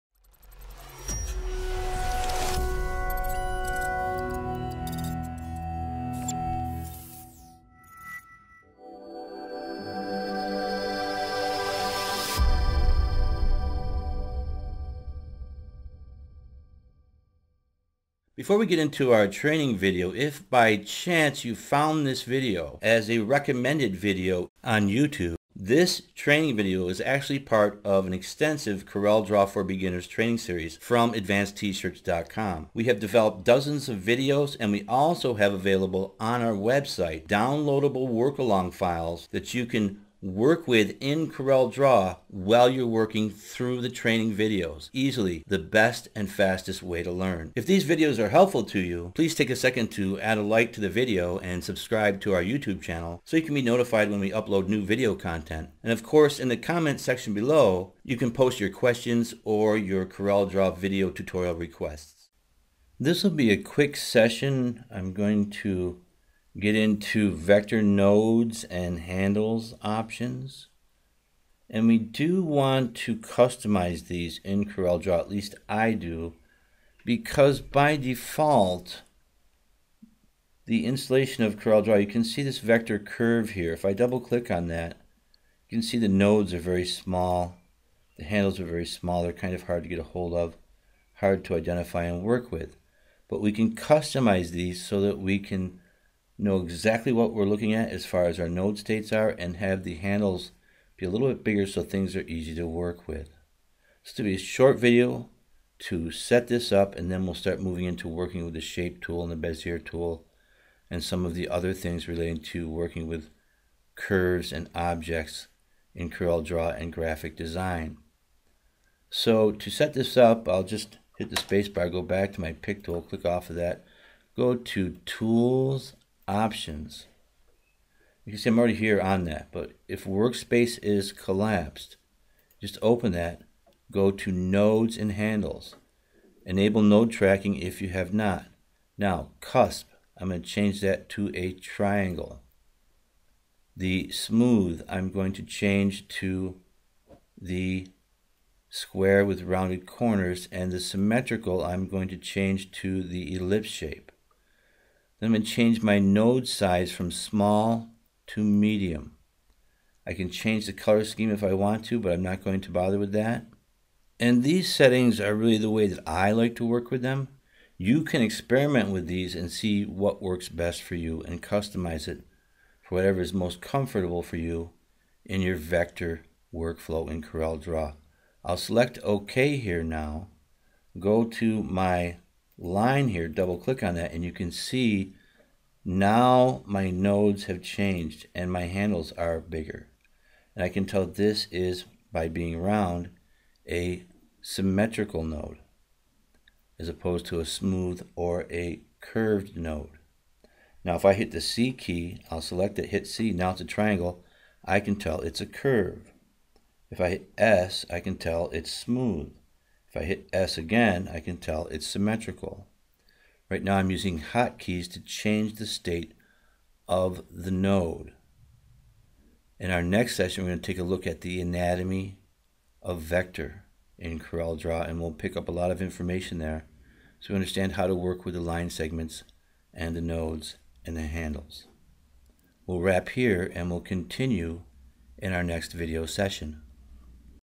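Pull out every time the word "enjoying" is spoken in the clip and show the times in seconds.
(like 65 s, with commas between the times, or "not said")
not said.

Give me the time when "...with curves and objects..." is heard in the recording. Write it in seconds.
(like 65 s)
113 s.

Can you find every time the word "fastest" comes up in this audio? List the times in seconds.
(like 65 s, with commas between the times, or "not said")
46 s.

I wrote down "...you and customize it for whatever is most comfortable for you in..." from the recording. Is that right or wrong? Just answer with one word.
right.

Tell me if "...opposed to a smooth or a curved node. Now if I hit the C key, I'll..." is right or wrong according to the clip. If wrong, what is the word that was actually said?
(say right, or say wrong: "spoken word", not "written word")
right.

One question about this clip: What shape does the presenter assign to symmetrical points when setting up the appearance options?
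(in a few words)
ellipse.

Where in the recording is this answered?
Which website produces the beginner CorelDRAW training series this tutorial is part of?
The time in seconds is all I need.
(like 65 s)
31 s.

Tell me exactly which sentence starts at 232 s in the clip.
We'll wrap here and we'll continue in our next video session.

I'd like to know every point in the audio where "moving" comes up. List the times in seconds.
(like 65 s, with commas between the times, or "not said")
107 s.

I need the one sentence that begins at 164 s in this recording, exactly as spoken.
And these settings are really the way that I like to work with them.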